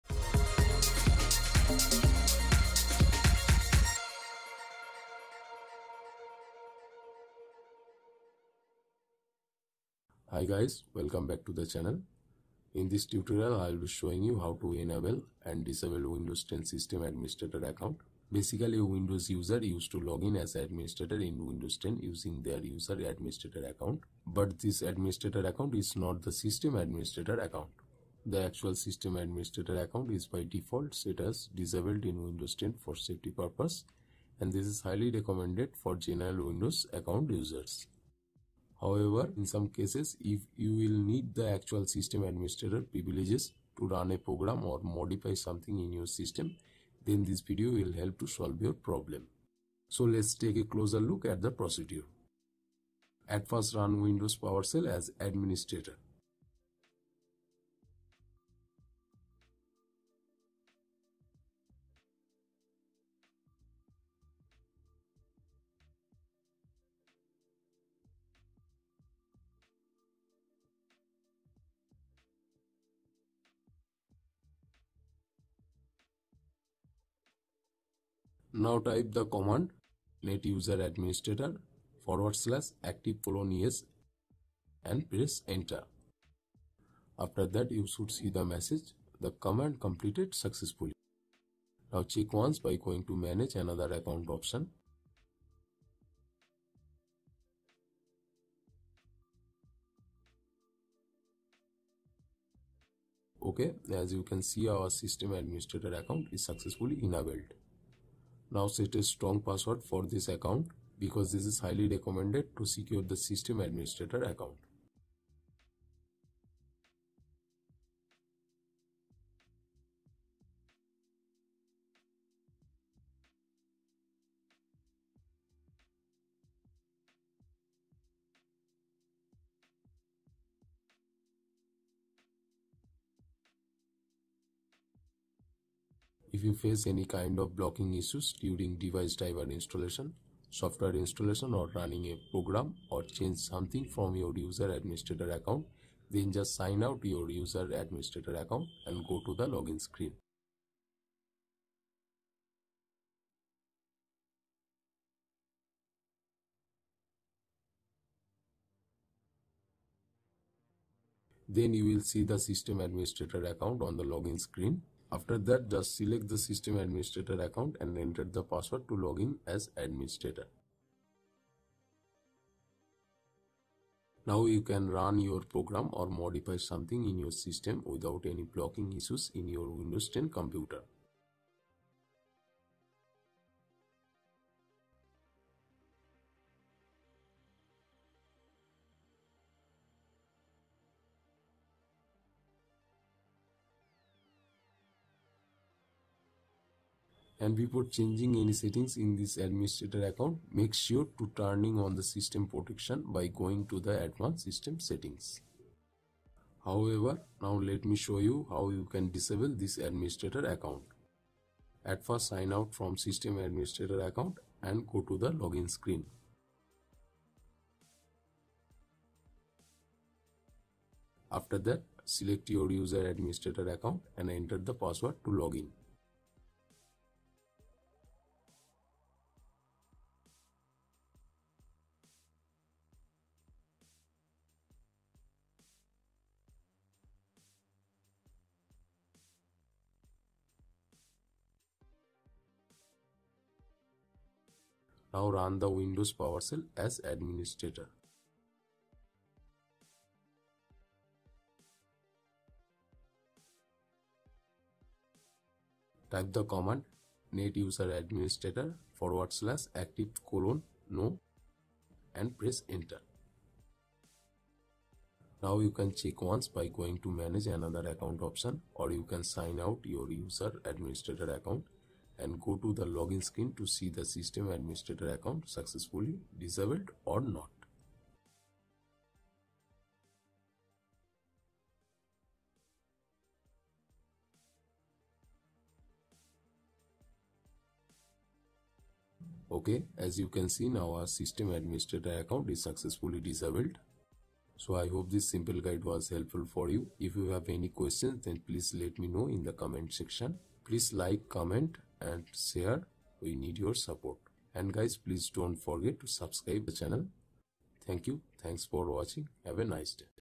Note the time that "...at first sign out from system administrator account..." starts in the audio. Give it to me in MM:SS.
03:31.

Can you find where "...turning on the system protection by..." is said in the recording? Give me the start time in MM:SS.
03:21.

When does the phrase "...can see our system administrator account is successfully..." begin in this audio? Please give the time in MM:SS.
01:44.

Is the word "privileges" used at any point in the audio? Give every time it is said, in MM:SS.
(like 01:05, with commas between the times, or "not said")
00:42.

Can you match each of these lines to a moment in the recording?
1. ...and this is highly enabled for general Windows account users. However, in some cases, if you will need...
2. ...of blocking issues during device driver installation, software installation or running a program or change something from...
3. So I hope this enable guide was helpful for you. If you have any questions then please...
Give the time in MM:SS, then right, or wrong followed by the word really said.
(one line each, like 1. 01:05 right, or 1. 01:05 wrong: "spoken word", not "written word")
1. 00:34 wrong: "recommended", not "enabled"
2. 02:17 right
3. 04:54 wrong: "simple", not "enable".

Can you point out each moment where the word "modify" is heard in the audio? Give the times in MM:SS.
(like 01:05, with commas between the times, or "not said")
00:44, 02:56.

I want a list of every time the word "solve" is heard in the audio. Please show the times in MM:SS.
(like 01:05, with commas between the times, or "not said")
00:48.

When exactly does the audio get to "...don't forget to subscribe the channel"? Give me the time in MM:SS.
05:05.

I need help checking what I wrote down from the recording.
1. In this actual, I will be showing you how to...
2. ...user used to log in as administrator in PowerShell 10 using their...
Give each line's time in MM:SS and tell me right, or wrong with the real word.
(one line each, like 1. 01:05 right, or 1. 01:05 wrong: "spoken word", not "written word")
1. 00:12 wrong: "tutorial", not "actual"
2. 00:19 wrong: "Windows", not "PowerShell".